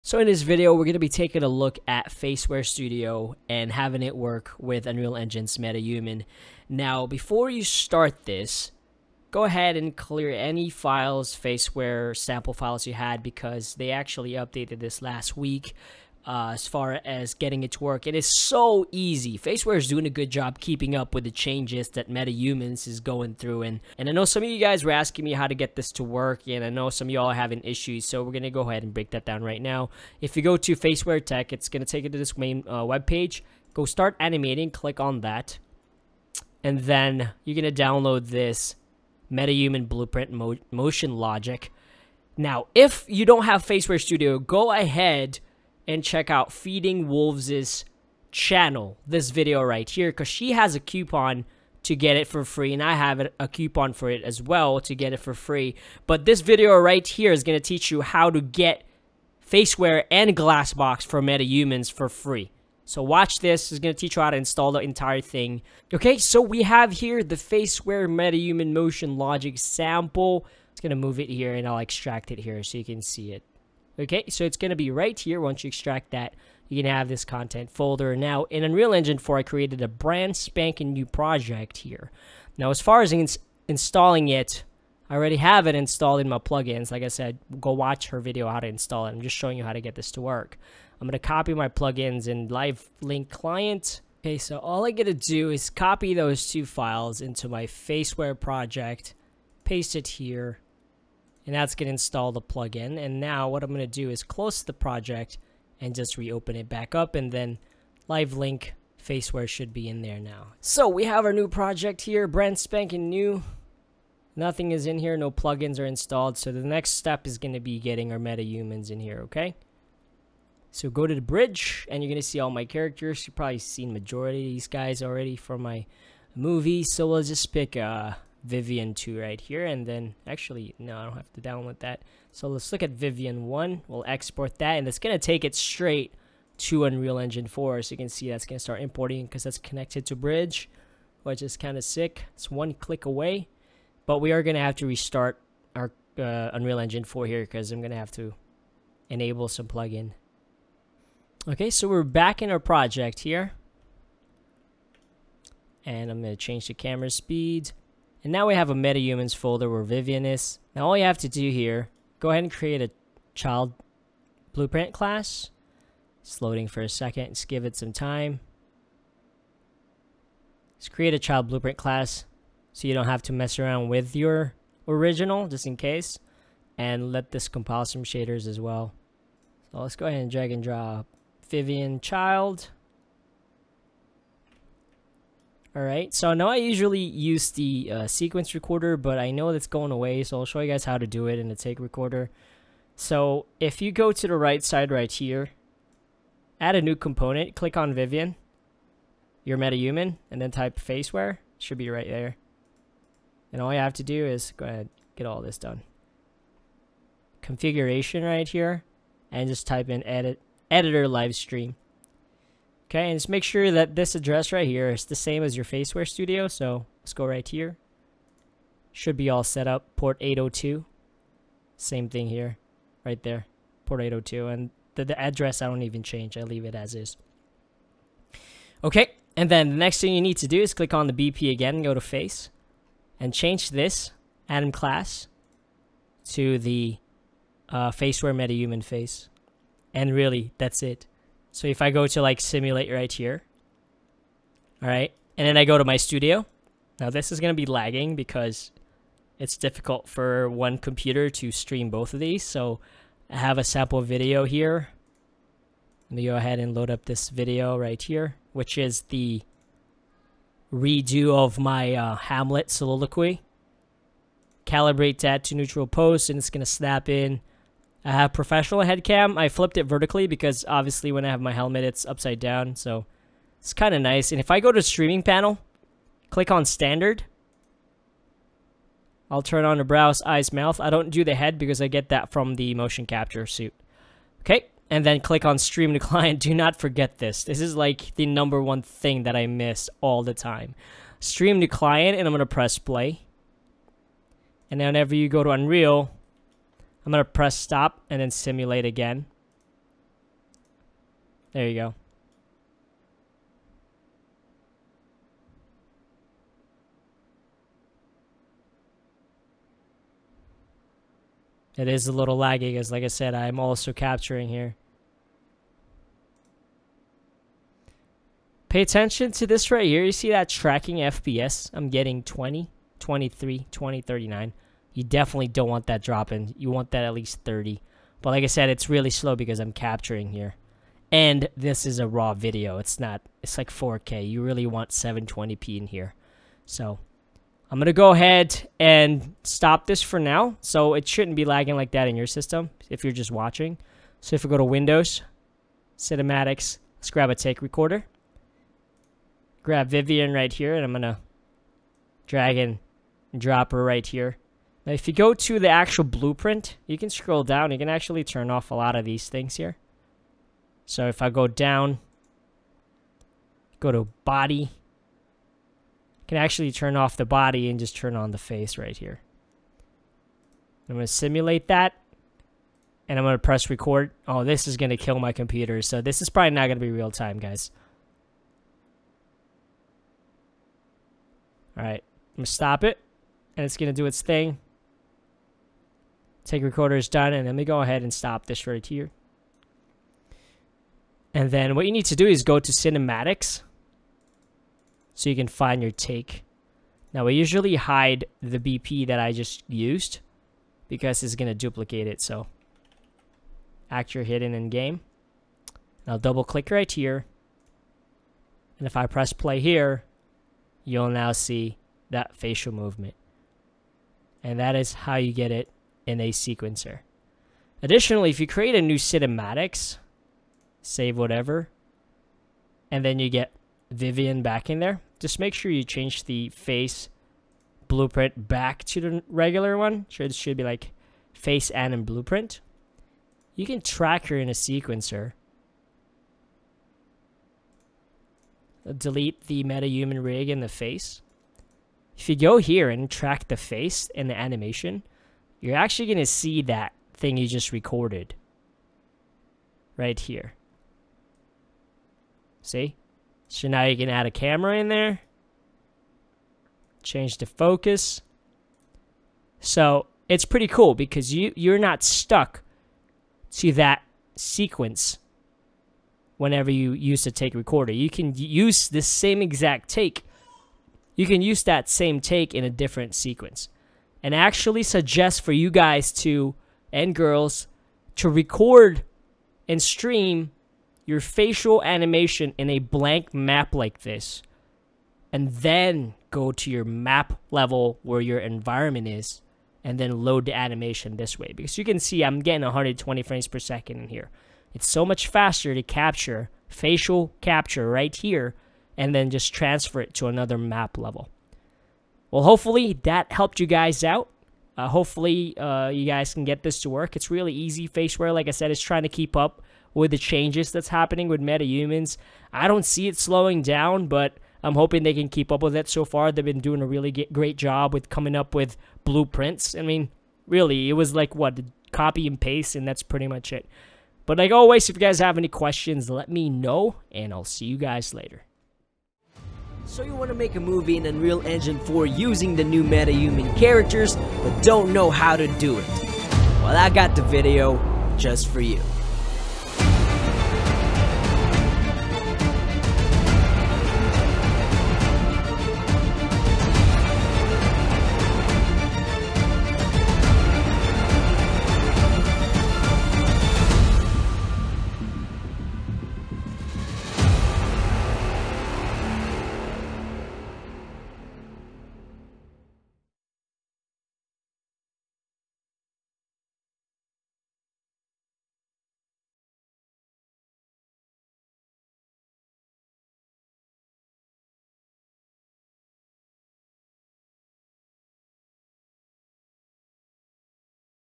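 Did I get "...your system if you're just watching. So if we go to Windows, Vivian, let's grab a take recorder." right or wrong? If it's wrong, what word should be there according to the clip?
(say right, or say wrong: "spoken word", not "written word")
wrong: "Cinematics", not "Vivian".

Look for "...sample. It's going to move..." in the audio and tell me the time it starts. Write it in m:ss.
1:09.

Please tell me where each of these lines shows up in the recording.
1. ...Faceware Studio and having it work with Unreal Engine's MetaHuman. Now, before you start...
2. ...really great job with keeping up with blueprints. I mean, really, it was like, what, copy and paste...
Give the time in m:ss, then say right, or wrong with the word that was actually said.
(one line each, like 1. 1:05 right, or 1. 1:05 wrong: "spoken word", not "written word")
1. 0:02 right
2. 8:36 wrong: "coming", not "keeping".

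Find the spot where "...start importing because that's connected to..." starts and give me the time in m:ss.
2:18.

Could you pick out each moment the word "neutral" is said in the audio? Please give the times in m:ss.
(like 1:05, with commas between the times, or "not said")
4:25.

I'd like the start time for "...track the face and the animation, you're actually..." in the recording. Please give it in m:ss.
7:23.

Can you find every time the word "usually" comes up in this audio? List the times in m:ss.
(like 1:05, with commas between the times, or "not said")
3:06, 6:37.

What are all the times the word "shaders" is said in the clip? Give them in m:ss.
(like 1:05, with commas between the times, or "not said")
2:58.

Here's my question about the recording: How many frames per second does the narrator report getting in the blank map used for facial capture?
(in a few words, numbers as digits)
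120.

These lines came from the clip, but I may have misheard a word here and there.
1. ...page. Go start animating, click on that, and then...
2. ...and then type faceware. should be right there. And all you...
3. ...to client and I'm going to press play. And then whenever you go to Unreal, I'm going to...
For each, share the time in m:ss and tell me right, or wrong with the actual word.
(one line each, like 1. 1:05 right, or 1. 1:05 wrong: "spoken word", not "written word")
1. 0:33 right
2. 3:20 right
3. 4:51 right.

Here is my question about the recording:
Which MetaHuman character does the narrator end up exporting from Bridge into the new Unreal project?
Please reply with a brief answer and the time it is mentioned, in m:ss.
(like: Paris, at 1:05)
Vivian 1, at 2:12.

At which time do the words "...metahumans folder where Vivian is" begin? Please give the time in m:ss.
2:38.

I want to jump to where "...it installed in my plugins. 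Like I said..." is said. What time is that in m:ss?
1:25.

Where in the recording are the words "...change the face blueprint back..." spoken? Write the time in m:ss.
7:05.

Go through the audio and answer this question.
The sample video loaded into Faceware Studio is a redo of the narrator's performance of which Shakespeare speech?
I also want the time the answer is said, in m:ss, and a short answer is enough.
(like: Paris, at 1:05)
Hamlet soliloquy, at 4:22.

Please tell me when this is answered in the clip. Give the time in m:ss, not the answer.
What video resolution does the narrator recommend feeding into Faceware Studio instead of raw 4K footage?
5:34.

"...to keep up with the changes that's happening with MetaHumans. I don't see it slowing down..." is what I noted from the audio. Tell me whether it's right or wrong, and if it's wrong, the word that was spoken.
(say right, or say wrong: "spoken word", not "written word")
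right.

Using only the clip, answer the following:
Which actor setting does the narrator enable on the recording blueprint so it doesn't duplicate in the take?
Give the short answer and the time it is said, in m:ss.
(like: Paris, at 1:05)
actor hidden in game, at 6:43.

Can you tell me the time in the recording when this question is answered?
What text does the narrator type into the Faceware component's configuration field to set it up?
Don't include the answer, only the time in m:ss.
3:30.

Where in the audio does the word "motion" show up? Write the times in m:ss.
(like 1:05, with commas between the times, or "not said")
0:40, 1:08, 4:42.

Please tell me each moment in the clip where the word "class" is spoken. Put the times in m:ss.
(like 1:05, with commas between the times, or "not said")
2:44, 2:51, 3:54.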